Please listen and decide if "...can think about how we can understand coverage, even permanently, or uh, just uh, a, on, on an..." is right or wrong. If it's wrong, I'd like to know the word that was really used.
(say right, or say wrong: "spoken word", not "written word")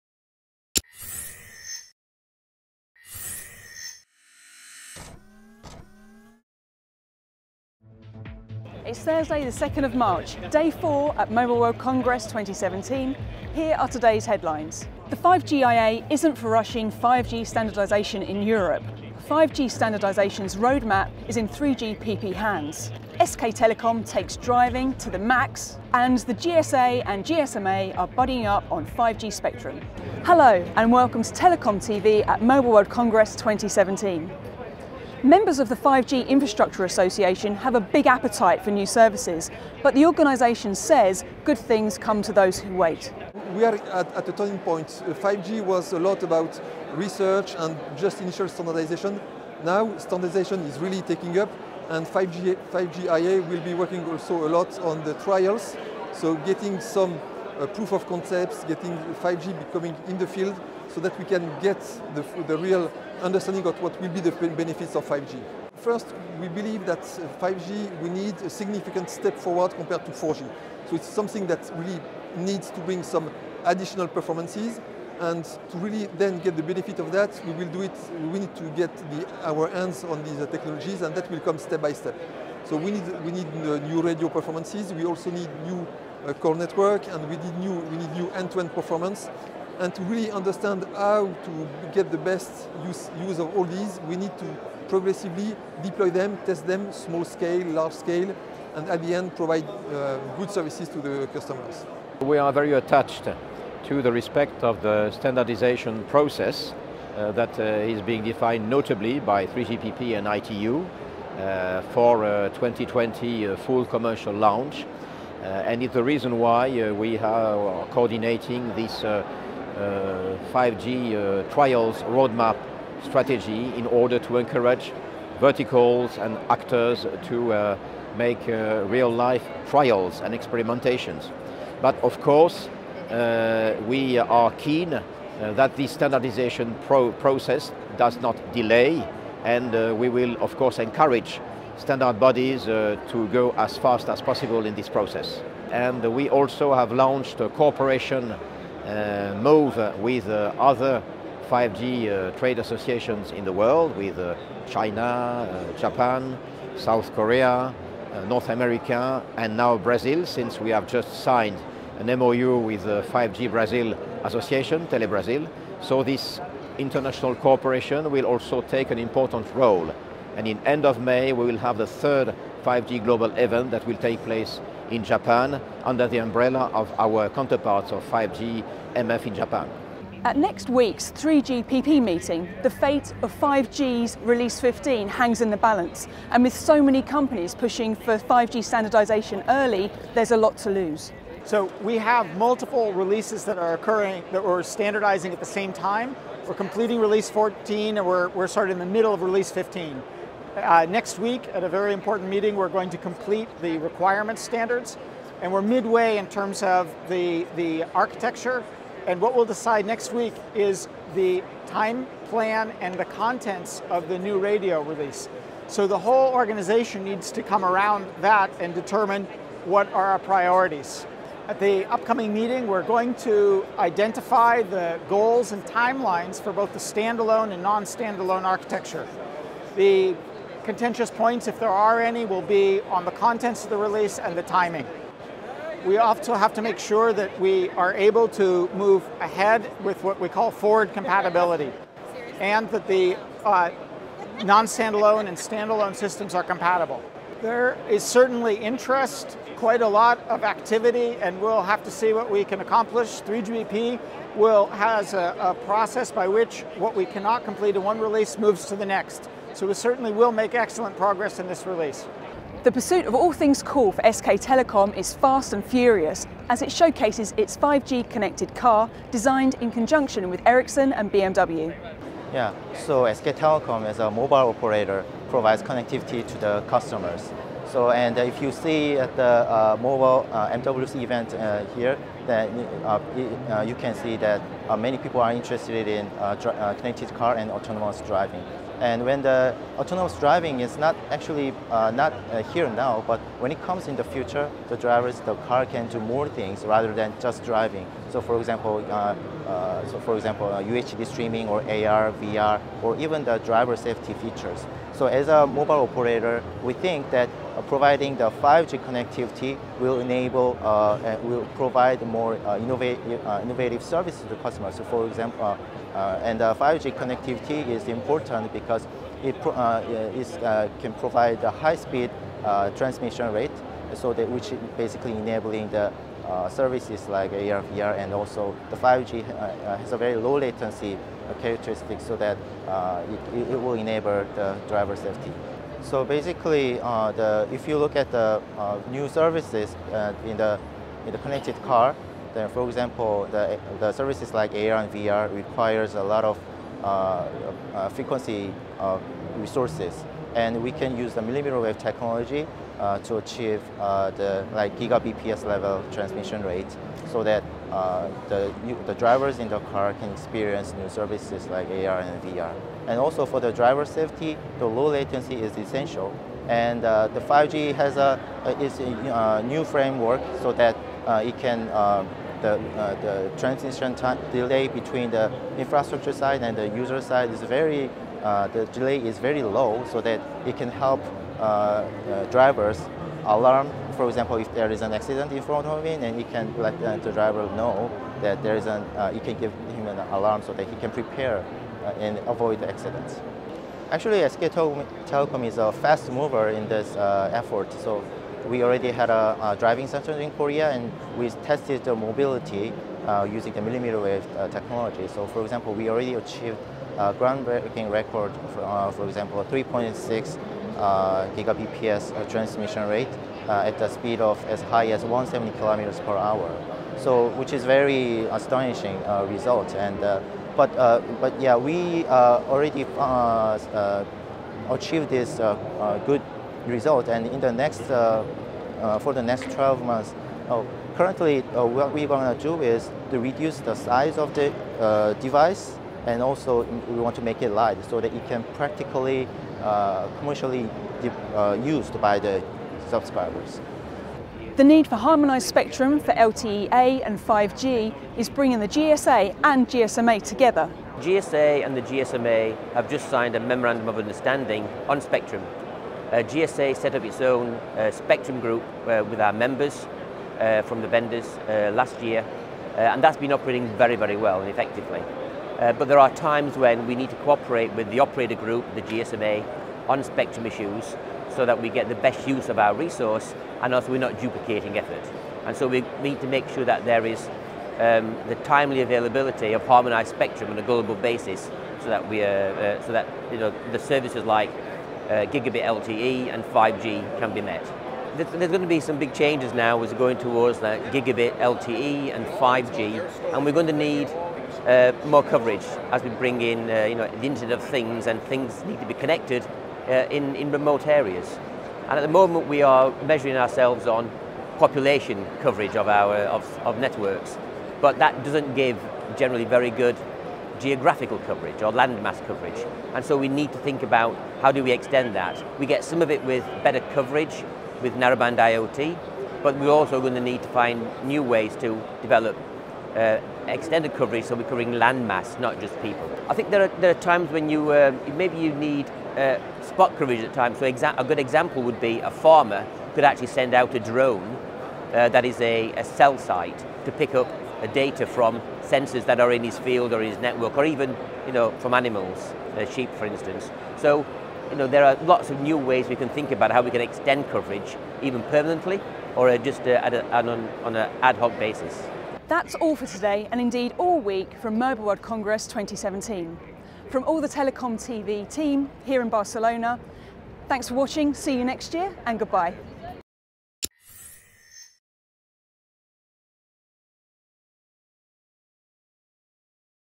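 wrong: "extend", not "understand".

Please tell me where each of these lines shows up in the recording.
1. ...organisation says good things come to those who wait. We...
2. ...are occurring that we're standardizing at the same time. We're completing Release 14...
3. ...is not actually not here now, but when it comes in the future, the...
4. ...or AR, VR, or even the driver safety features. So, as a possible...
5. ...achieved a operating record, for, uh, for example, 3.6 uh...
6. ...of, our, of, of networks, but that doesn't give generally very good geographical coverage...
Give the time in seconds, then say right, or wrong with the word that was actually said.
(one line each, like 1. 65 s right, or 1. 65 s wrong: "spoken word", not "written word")
1. 40 s right
2. 193 s right
3. 290 s right
4. 301 s wrong: "mobile", not "possible"
5. 406 s wrong: "groundbreaking", not "operating"
6. 505 s right.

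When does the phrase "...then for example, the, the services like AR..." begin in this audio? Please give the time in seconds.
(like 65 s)
342 s.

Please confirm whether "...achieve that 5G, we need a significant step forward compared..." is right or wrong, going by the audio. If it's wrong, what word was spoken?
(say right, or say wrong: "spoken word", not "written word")
wrong: "believe", not "achieve".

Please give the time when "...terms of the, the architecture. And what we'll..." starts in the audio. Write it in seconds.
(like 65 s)
206 s.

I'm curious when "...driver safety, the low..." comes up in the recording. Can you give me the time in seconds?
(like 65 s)
363 s.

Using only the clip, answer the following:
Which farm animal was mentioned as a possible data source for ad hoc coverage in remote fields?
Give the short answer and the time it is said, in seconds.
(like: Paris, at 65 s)
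Sheep, at 542 s.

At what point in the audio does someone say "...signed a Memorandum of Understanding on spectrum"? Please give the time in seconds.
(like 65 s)
453 s.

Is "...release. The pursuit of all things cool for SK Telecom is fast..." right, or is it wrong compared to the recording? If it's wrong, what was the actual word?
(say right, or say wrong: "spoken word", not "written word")
right.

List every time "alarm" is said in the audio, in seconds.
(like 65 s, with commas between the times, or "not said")
383 s, 390 s.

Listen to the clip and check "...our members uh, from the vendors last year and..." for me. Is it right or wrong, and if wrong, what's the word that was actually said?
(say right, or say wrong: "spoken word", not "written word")
right.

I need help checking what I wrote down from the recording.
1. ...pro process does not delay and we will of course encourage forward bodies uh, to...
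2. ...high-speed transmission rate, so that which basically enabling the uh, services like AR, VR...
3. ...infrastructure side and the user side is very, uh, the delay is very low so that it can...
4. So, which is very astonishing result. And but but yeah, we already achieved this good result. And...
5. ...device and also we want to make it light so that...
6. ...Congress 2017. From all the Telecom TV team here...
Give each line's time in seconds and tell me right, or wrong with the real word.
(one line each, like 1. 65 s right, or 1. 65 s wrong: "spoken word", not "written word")
1. 136 s wrong: "standard", not "forward"
2. 321 s right
3. 375 s right
4. 416 s right
5. 435 s right
6. 555 s right.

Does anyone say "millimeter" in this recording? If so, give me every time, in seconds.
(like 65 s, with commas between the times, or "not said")
351 s, 403 s.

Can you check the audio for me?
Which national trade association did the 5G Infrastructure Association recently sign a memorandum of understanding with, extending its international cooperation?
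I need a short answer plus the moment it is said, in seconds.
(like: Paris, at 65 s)
5G Brazil Association, at 163 s.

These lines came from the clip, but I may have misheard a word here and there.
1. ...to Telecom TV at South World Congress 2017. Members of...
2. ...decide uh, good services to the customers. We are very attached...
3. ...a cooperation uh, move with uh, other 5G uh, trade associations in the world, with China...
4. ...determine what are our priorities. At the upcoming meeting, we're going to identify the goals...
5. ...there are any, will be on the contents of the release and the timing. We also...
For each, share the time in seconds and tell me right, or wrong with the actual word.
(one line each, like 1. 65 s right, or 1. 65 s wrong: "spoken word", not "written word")
1. 31 s wrong: "Mobile", not "South"
2. 99 s wrong: "provide", not "decide"
3. 147 s right
4. 218 s right
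5. 231 s right.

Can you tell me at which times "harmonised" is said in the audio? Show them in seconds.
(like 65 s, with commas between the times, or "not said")
444 s, 479 s.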